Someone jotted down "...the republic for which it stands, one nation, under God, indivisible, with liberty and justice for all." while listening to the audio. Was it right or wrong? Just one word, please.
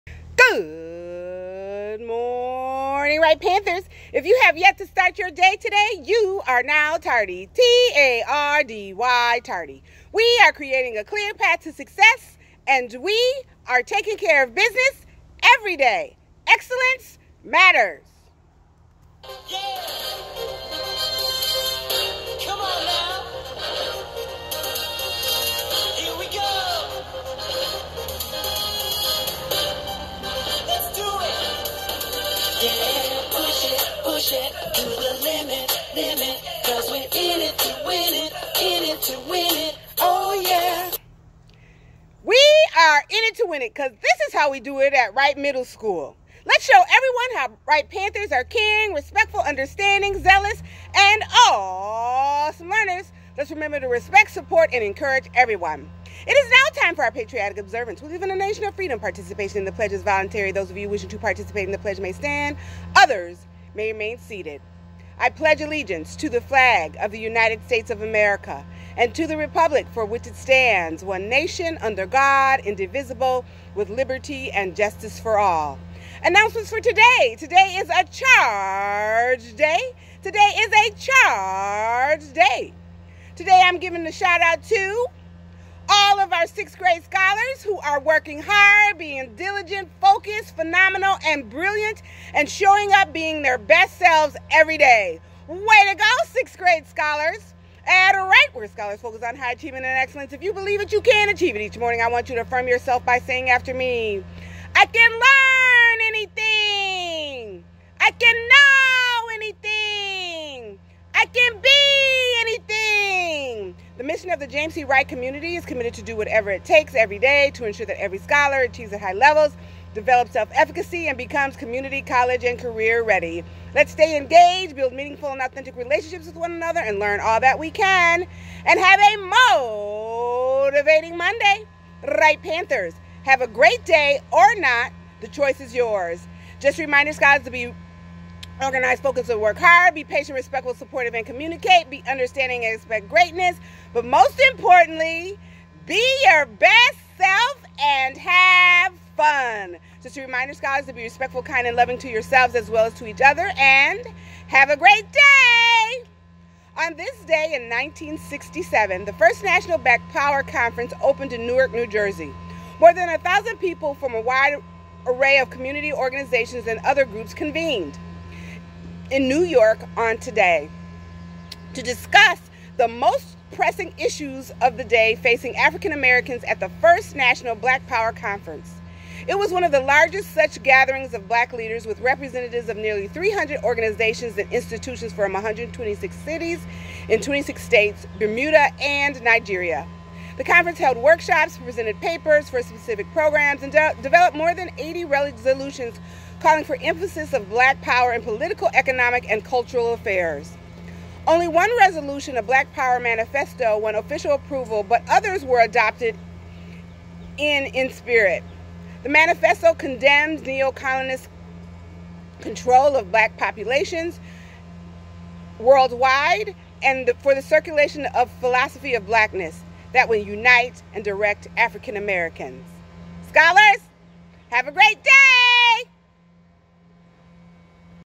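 right.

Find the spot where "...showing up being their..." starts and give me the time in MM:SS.
01:32.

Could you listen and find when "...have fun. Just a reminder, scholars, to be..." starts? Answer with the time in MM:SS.
02:28.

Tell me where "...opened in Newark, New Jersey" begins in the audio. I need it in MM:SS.
02:41.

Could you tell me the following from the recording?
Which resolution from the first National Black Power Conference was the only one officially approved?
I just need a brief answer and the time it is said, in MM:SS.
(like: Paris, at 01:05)
Black Power Manifesto, at 03:22.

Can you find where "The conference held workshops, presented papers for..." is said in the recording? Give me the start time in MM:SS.
03:10.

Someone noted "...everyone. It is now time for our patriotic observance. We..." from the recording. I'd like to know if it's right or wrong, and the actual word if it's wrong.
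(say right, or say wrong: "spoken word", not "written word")
right.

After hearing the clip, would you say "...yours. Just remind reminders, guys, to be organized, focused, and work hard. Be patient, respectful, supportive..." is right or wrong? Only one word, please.
right.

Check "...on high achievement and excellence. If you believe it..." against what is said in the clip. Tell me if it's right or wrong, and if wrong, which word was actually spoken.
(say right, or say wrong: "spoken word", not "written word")
right.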